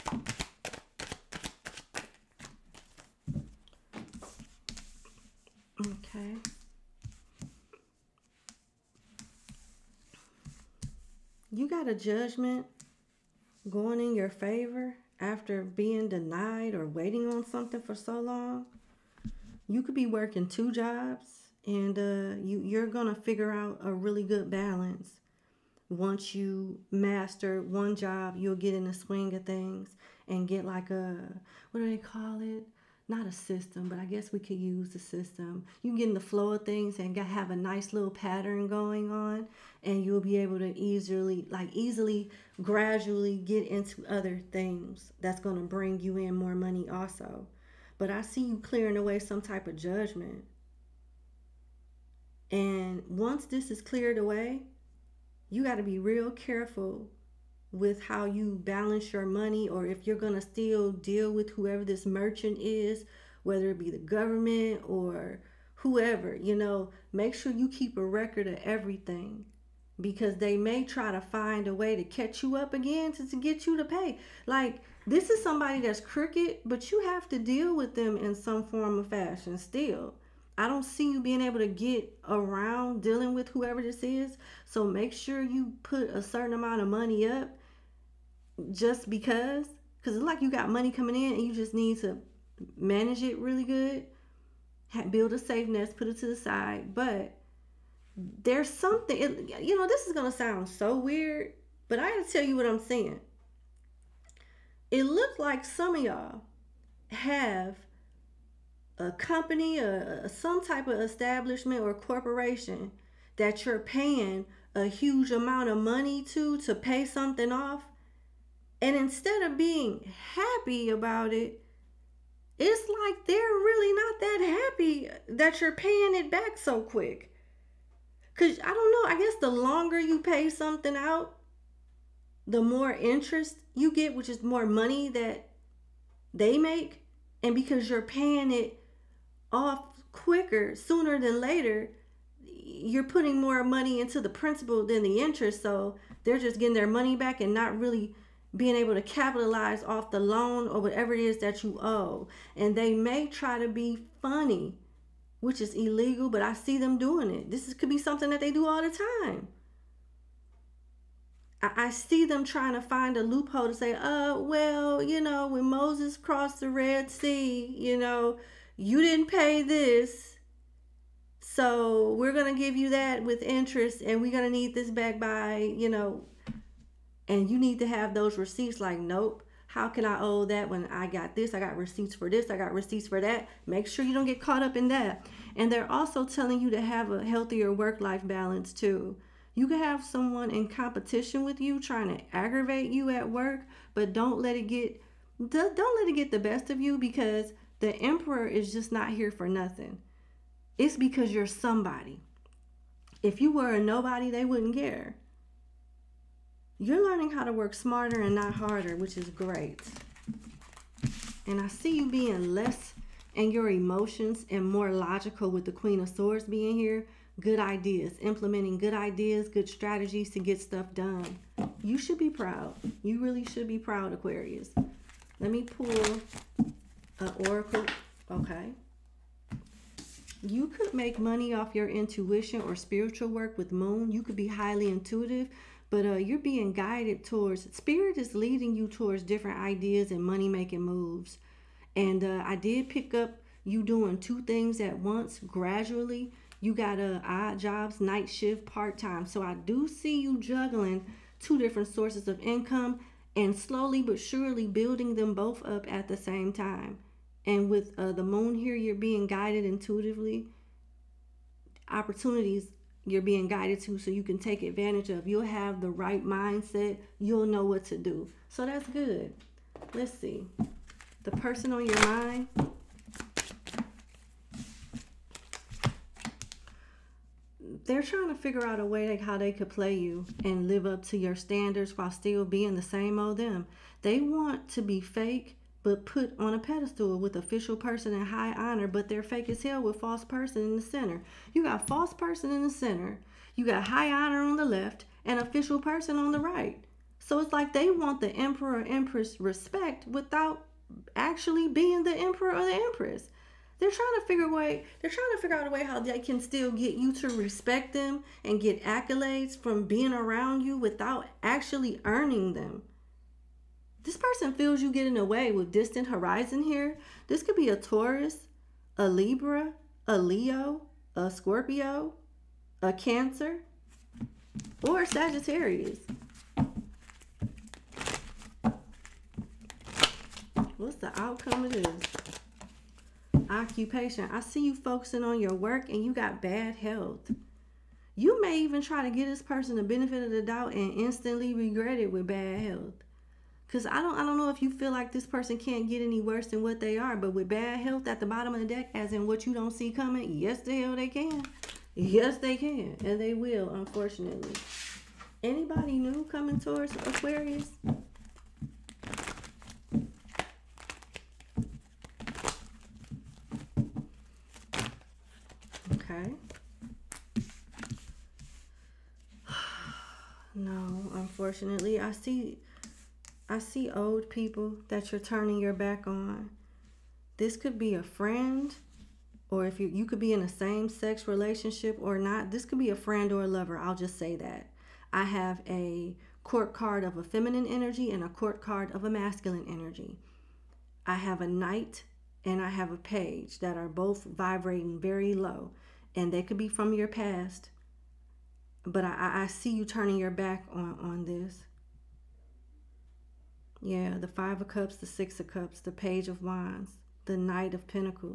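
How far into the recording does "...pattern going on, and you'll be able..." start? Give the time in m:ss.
0:38.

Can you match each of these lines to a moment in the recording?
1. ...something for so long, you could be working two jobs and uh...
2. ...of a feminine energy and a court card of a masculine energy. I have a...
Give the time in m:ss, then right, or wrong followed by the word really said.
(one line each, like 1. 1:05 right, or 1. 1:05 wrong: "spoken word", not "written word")
1. 0:17 right
2. 6:27 right.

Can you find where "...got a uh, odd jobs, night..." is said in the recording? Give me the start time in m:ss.
4:06.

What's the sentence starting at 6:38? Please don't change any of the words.
But I, I see you turning your back on, on this.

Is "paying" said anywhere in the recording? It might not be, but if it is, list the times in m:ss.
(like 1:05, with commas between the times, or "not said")
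1:53, 2:05, 2:18.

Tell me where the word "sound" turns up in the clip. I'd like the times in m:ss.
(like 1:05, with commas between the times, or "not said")
1:40.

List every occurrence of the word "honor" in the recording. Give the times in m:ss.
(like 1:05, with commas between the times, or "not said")
4:48, 4:54.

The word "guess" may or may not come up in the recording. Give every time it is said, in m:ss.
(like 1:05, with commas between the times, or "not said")
0:34, 2:09.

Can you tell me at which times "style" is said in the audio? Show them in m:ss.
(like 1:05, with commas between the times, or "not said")
not said.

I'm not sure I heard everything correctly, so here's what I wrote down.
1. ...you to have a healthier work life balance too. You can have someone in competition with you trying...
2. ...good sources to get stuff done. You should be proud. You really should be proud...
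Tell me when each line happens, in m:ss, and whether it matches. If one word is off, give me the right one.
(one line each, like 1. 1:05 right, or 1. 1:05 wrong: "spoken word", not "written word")
1. 3:06 right
2. 3:39 wrong: "strategies", not "sources".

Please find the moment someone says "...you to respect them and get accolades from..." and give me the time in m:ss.
5:06.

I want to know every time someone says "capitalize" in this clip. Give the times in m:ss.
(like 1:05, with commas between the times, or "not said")
2:29.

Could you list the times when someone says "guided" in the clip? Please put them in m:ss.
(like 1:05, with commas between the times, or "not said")
3:56, 4:19, 4:23.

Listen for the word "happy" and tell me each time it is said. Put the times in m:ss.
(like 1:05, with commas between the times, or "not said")
2:00, 2:04.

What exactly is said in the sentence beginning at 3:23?
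If you were a nobody, they wouldn't care.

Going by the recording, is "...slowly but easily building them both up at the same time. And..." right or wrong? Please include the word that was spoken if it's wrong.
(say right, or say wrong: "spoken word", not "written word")
wrong: "surely", not "easily".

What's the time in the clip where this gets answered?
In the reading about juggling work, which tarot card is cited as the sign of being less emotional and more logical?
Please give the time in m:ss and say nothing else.
3:35.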